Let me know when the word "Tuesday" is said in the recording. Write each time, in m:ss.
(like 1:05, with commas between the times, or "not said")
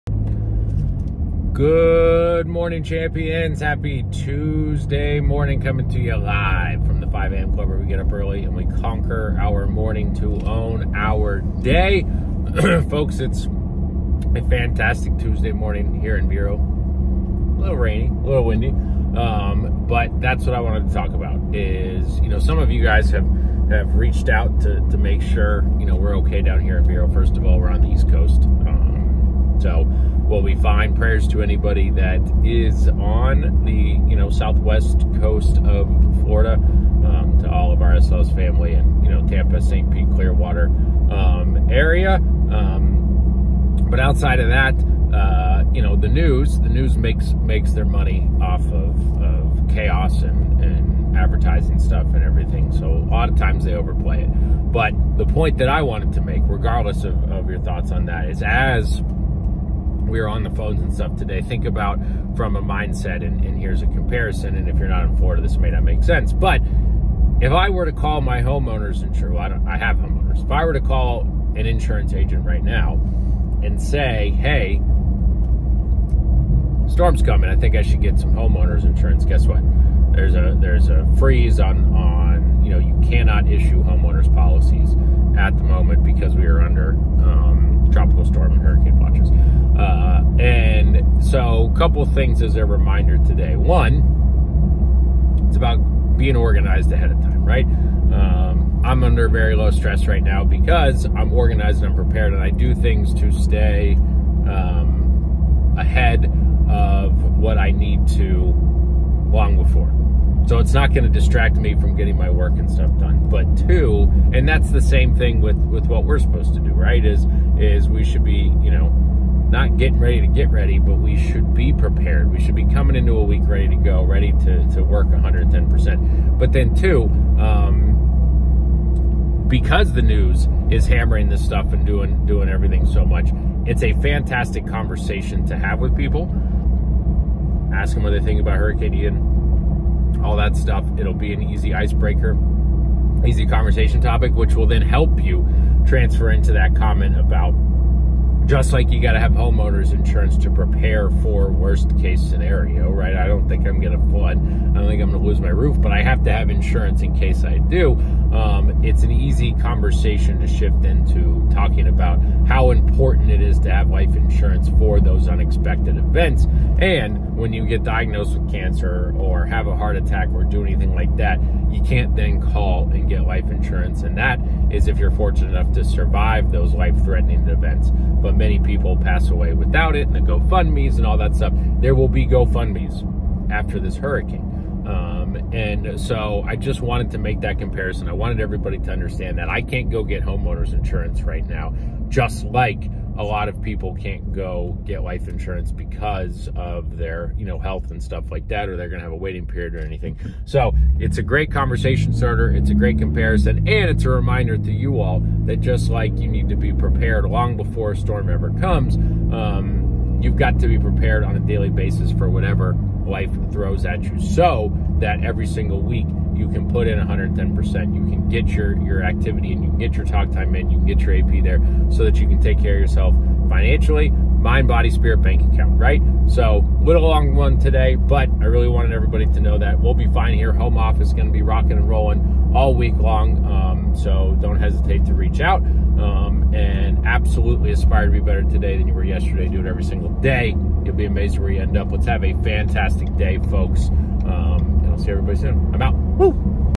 0:04, 0:15.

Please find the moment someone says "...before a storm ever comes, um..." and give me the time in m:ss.
3:27.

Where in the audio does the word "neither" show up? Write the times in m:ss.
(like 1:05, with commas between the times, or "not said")
not said.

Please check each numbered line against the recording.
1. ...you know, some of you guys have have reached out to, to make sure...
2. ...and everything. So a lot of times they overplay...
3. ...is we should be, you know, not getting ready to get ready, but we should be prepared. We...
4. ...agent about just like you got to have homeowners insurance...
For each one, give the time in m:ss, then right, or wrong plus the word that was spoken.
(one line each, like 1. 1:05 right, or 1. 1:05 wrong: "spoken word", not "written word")
1. 0:22 right
2. 0:52 right
3. 1:57 right
4. 2:26 wrong: "comment", not "agent".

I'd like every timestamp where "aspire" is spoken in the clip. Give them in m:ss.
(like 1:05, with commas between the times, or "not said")
3:57.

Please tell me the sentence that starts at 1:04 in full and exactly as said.
And if you're not in Florida, this may not make sense.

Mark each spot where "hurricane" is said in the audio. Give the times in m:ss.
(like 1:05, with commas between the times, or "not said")
1:28, 2:18, 3:03.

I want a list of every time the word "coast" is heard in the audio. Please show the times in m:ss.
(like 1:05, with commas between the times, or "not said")
0:28, 0:35.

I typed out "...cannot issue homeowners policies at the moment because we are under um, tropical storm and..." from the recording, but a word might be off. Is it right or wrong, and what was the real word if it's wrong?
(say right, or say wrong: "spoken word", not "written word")
right.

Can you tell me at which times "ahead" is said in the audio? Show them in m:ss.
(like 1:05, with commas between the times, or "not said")
1:36, 1:45.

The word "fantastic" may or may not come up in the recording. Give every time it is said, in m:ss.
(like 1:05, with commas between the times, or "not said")
0:14, 2:14, 4:02.